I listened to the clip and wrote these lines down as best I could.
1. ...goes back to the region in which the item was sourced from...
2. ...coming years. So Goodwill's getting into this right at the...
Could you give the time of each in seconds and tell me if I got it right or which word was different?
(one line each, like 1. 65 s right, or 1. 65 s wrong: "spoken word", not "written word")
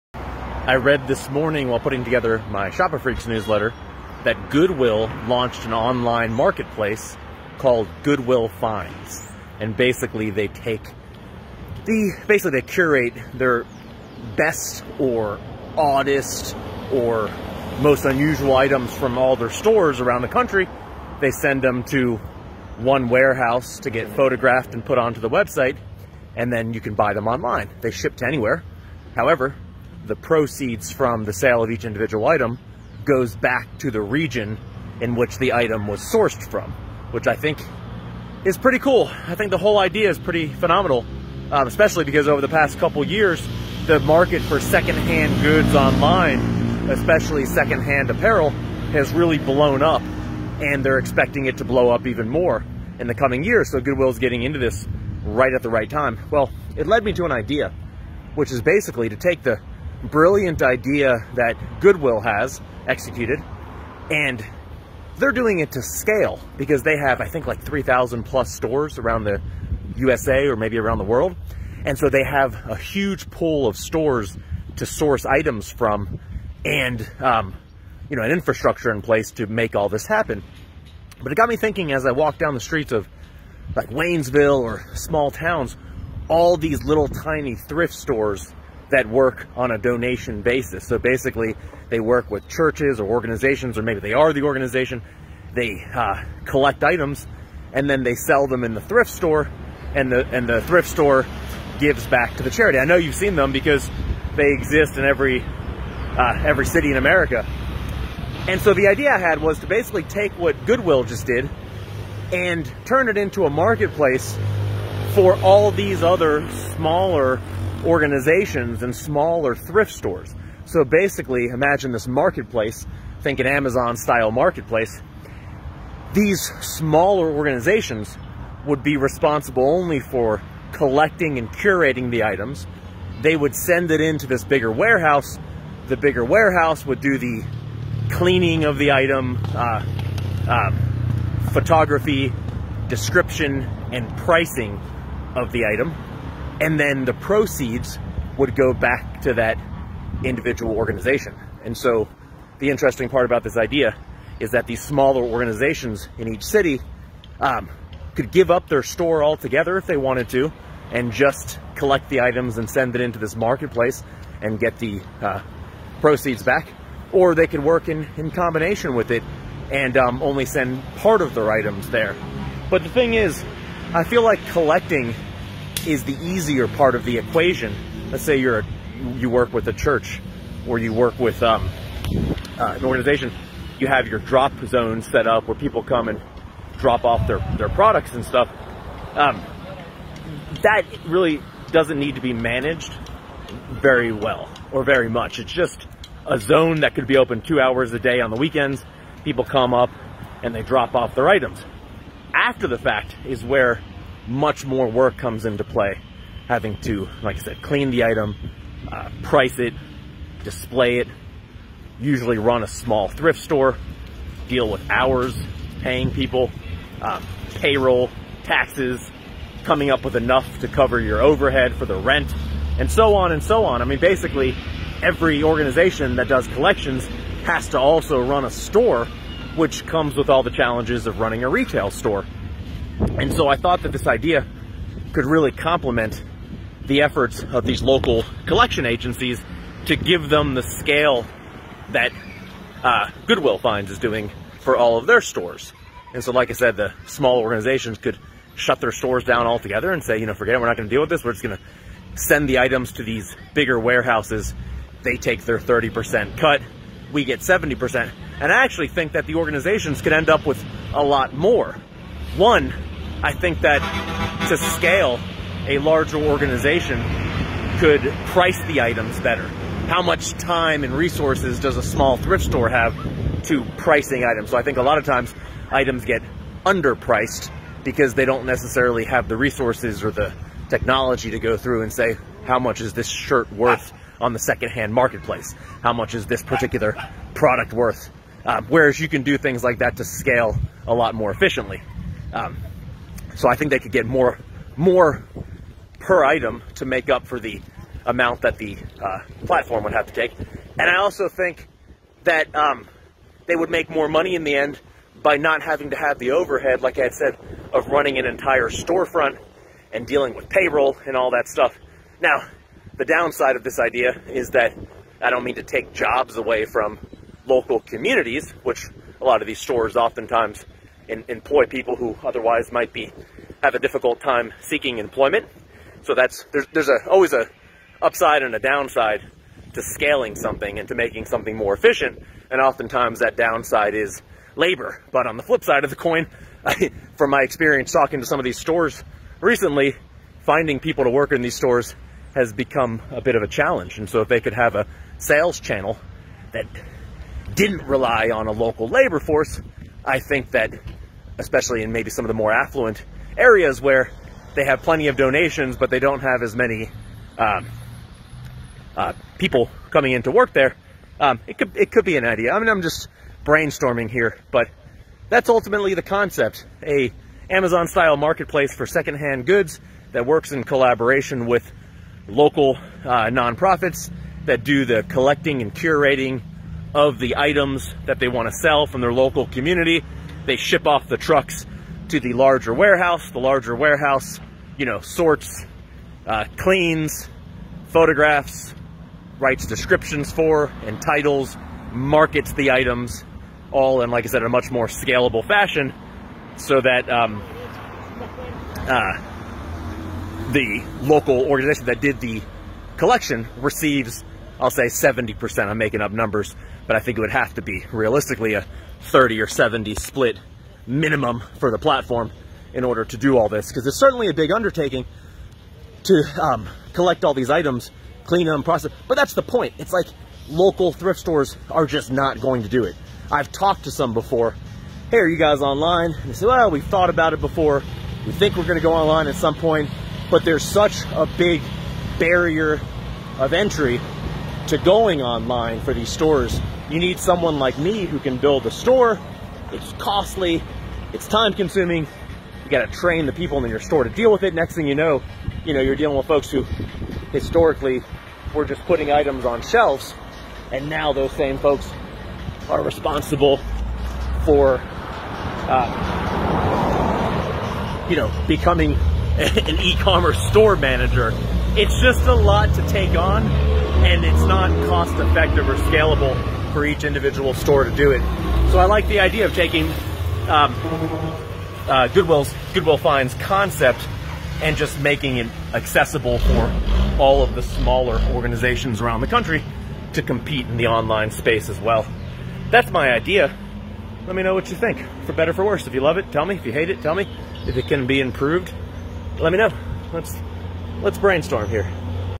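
1. 33 s right
2. 53 s right.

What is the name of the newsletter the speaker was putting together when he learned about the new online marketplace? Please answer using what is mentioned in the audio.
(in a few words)
Shopifreaks.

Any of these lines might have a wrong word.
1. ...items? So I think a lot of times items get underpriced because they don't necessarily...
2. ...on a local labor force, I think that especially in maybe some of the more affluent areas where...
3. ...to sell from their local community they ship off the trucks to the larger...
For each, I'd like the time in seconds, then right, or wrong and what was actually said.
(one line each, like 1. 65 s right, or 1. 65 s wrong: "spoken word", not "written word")
1. 274 s right
2. 348 s right
3. 378 s right.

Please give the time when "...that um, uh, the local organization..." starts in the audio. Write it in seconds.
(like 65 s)
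396 s.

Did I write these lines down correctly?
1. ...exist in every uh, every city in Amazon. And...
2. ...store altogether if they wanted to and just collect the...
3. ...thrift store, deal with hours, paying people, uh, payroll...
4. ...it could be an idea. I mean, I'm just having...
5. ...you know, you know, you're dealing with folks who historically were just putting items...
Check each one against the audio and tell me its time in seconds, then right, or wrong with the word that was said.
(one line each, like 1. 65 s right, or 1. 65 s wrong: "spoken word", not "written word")
1. 104 s wrong: "America", not "Amazon"
2. 158 s right
3. 213 s right
4. 361 s wrong: "brainstorming", not "having"
5. 444 s right.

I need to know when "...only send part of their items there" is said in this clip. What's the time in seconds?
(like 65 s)
170 s.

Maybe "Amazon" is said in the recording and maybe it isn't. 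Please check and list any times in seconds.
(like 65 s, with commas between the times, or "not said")
123 s, 367 s.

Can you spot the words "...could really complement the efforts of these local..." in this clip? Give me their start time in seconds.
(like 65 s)
235 s.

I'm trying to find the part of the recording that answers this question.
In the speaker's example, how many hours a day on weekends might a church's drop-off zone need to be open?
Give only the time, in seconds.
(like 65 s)
197 s.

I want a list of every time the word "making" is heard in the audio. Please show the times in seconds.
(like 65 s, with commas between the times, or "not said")
330 s, 405 s, 474 s.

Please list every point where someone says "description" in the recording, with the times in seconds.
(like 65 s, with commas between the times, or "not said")
142 s, 389 s.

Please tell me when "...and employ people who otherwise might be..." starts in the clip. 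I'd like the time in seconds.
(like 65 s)
321 s.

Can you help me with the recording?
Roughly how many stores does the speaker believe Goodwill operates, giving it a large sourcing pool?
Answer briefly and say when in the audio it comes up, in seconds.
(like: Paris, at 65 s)
3,000 plus, at 67 s.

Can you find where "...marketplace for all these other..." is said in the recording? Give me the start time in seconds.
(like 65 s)
113 s.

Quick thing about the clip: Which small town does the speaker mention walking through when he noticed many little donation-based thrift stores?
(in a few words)
Waynesville.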